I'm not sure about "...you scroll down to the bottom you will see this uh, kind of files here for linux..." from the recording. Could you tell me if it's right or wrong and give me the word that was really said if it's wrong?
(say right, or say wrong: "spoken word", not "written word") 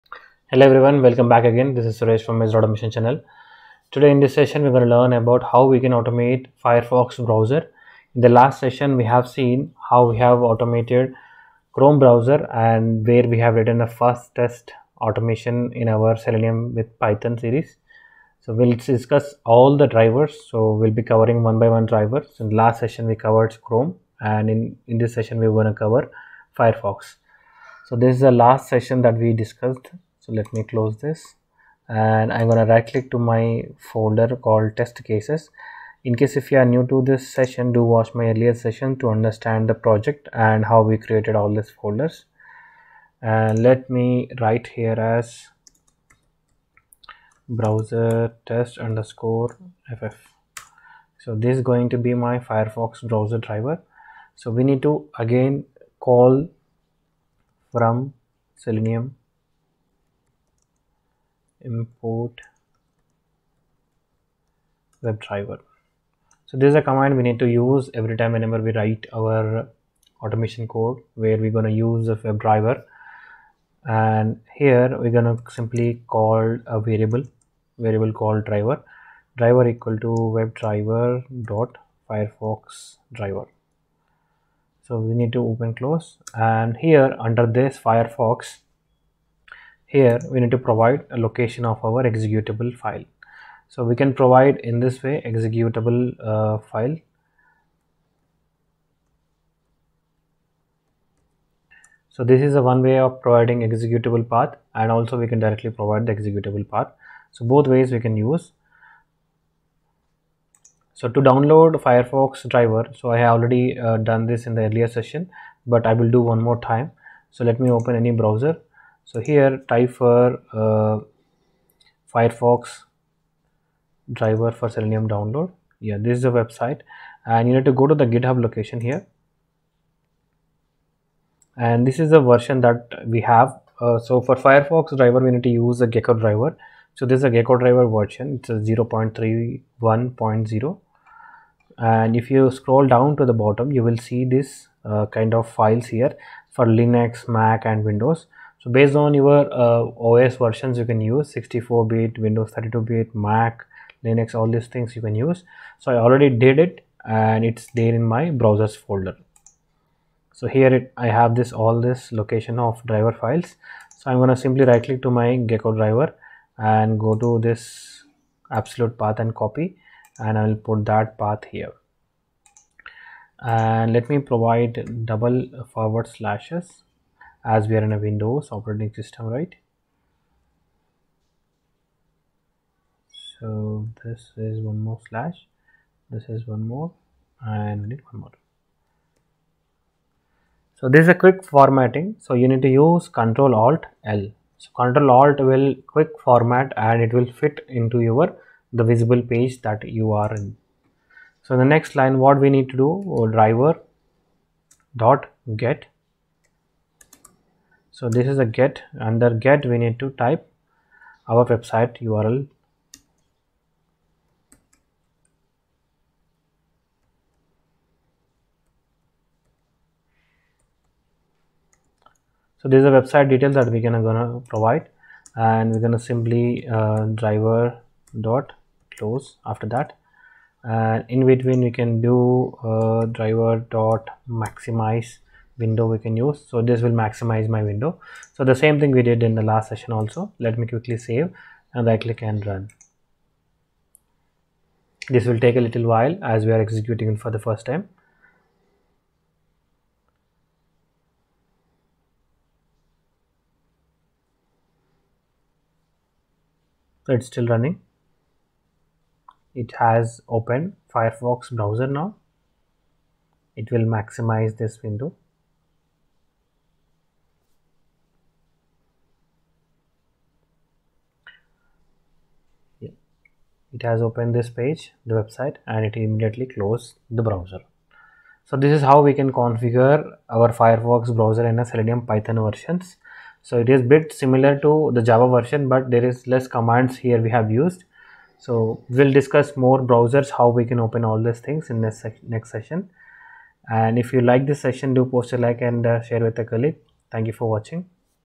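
right.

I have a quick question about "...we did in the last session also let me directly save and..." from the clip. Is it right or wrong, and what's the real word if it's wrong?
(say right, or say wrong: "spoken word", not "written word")
wrong: "quickly", not "directly".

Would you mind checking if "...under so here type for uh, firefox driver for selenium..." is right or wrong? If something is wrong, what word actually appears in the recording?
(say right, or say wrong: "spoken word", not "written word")
wrong: "browser", not "under".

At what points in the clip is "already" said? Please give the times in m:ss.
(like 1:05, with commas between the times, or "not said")
1:53, 2:36.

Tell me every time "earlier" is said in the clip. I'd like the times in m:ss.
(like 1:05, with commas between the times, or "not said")
0:38, 1:54.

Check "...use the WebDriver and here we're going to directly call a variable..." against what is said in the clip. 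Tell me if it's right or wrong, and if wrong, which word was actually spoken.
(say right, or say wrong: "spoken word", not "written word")
wrong: "simply", not "directly".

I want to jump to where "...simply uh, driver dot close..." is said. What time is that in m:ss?
3:45.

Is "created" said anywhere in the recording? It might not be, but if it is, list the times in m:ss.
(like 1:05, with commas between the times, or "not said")
0:40.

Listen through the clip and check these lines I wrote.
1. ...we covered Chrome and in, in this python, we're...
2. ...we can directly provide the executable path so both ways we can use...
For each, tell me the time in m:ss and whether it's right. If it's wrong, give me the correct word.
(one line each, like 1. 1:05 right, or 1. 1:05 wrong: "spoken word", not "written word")
1. 0:23 wrong: "session", not "python"
2. 1:45 right.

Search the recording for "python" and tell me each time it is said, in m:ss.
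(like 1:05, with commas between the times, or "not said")
0:16, 4:42.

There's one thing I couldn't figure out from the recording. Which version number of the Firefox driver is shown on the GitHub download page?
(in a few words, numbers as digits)
0.31.0.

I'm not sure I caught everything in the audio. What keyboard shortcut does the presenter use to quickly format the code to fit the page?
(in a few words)
Control Alt L.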